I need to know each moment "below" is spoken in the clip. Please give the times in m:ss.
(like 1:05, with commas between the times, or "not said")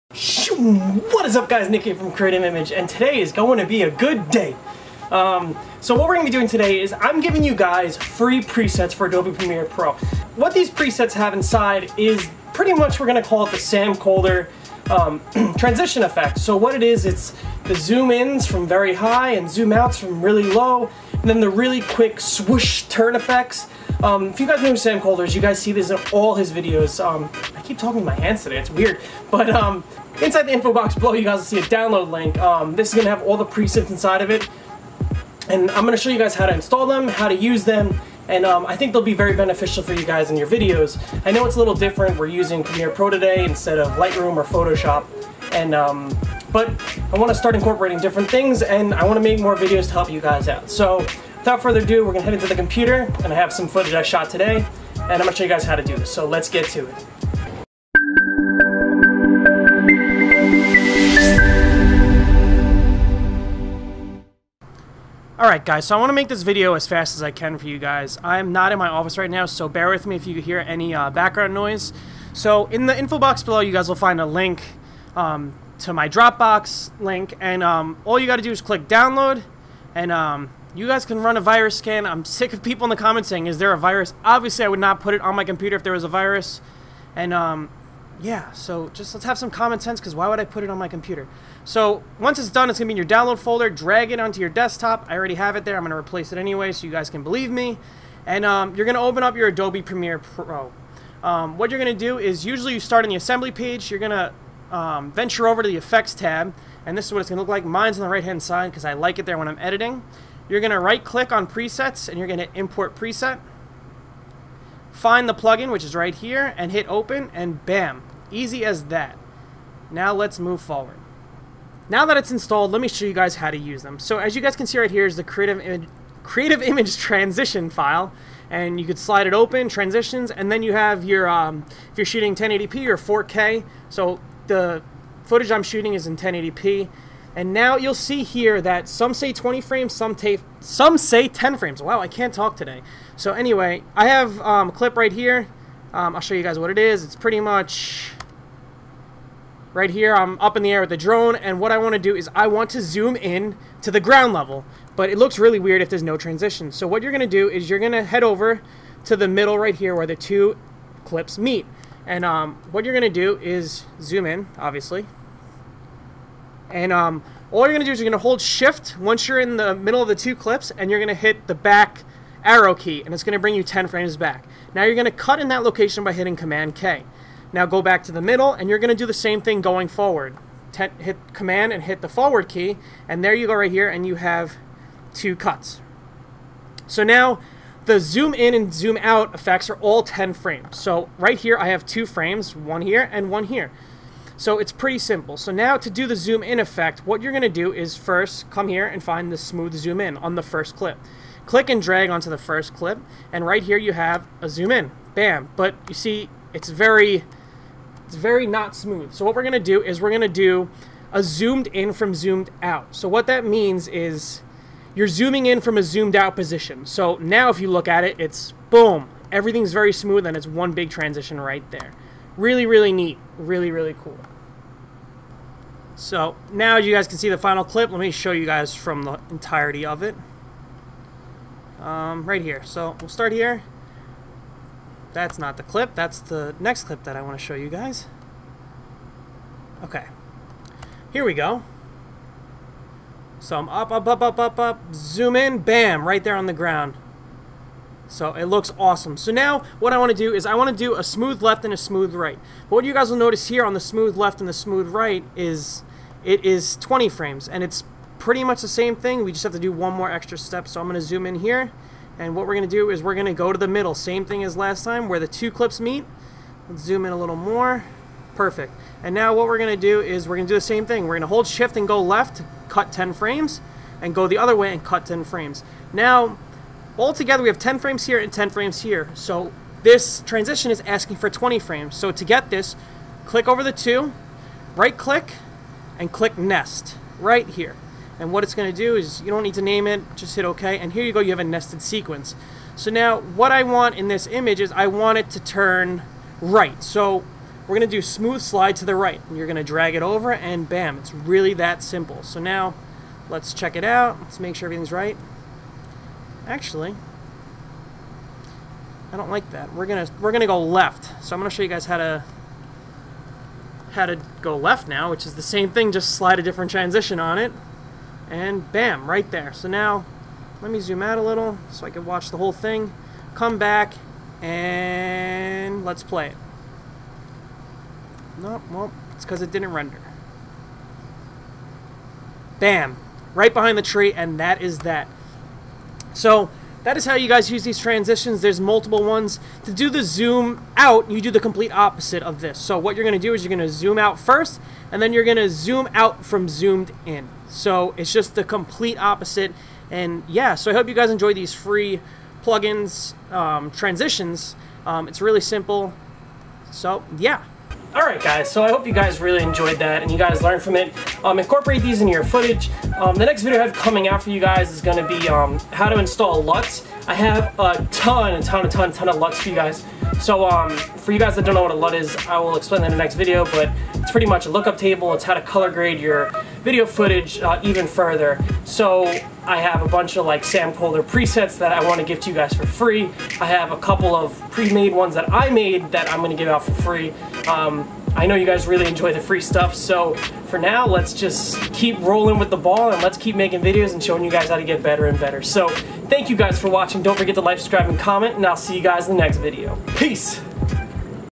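0:30, 1:13.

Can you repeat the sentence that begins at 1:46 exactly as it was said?
And this is what it's going to look like.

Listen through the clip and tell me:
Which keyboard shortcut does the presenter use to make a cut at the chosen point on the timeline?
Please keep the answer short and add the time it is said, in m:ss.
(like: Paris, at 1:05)
Command K, at 2:56.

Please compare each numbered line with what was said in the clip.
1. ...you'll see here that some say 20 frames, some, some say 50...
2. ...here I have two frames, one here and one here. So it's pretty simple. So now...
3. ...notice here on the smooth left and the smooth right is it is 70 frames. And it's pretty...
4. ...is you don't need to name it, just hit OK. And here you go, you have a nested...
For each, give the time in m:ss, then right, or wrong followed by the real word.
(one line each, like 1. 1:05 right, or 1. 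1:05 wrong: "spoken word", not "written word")
1. 2:17 wrong: "10", not "50"
2. 3:11 right
3. 4:13 wrong: "20", not "70"
4. 4:48 right.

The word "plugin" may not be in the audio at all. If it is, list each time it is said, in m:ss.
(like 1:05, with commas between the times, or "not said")
1:55, 5:52.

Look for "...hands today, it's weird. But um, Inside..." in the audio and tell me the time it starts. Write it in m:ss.
0:28.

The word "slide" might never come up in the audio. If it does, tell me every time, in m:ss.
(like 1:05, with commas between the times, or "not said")
2:08, 4:58, 5:16.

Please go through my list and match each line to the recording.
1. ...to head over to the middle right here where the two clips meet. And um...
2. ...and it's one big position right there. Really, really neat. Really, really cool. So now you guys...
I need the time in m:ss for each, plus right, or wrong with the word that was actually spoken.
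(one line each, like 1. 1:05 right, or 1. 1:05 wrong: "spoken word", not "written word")
1. 2:37 right
2. 3:40 wrong: "transition", not "position".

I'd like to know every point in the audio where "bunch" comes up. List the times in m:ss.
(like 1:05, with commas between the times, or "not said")
6:19.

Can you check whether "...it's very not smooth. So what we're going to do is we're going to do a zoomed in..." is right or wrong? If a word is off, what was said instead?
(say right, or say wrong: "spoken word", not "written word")
right.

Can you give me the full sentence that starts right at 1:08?
I'm not in my office right now, so bear with me if you hear any uh, background noise.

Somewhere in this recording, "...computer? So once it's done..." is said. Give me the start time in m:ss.
1:30.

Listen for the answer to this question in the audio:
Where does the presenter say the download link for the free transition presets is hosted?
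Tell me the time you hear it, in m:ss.
1:16.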